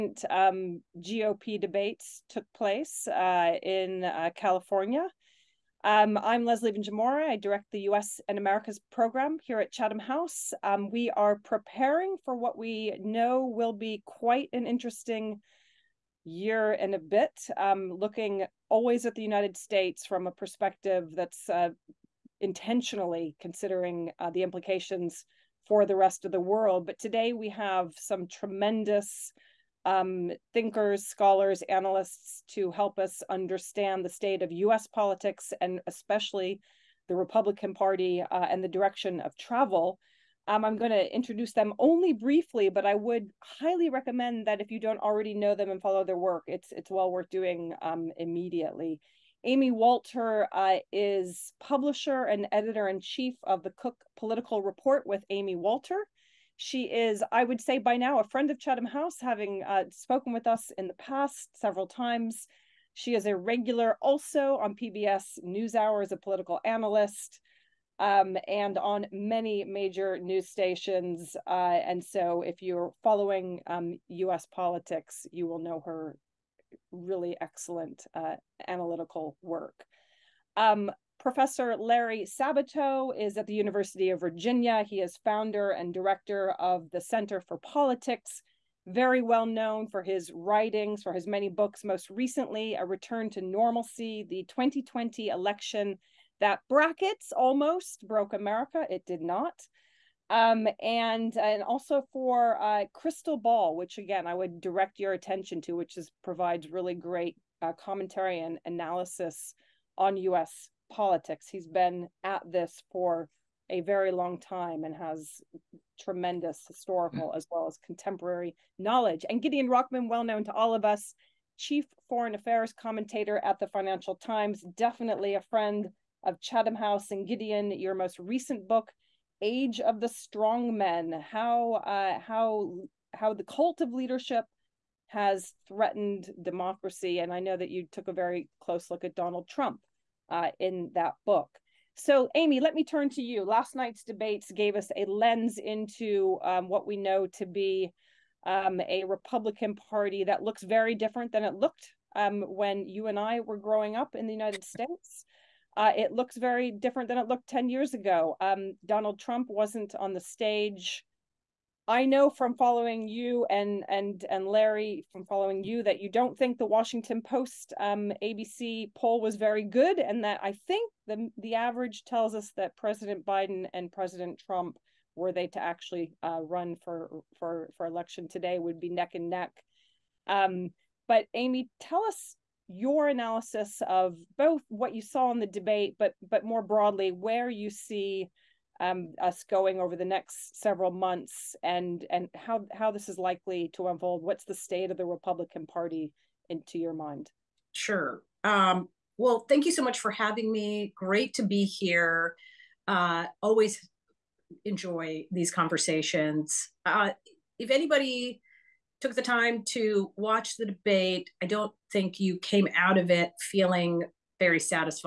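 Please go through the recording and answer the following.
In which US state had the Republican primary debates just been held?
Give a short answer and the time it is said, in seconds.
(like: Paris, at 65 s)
California, at 4 s.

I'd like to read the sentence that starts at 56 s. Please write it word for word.
She is, I would say, by now a friend of Chatham House, having uh, spoken with us in the past several times.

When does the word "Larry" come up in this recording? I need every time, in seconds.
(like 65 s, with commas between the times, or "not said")
81 s, 164 s.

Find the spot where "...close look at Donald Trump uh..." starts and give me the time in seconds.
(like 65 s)
138 s.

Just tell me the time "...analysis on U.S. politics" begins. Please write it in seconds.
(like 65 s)
108 s.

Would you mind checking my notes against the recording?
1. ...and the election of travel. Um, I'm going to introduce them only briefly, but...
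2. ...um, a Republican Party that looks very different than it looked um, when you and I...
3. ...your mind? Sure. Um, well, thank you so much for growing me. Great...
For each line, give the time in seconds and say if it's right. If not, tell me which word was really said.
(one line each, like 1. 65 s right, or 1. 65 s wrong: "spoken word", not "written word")
1. 38 s wrong: "direction", not "election"
2. 148 s right
3. 196 s wrong: "having", not "growing".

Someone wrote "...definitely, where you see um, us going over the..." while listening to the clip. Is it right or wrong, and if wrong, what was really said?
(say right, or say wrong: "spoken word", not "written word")
wrong: "broadly", not "definitely".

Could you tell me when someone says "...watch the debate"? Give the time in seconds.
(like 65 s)
210 s.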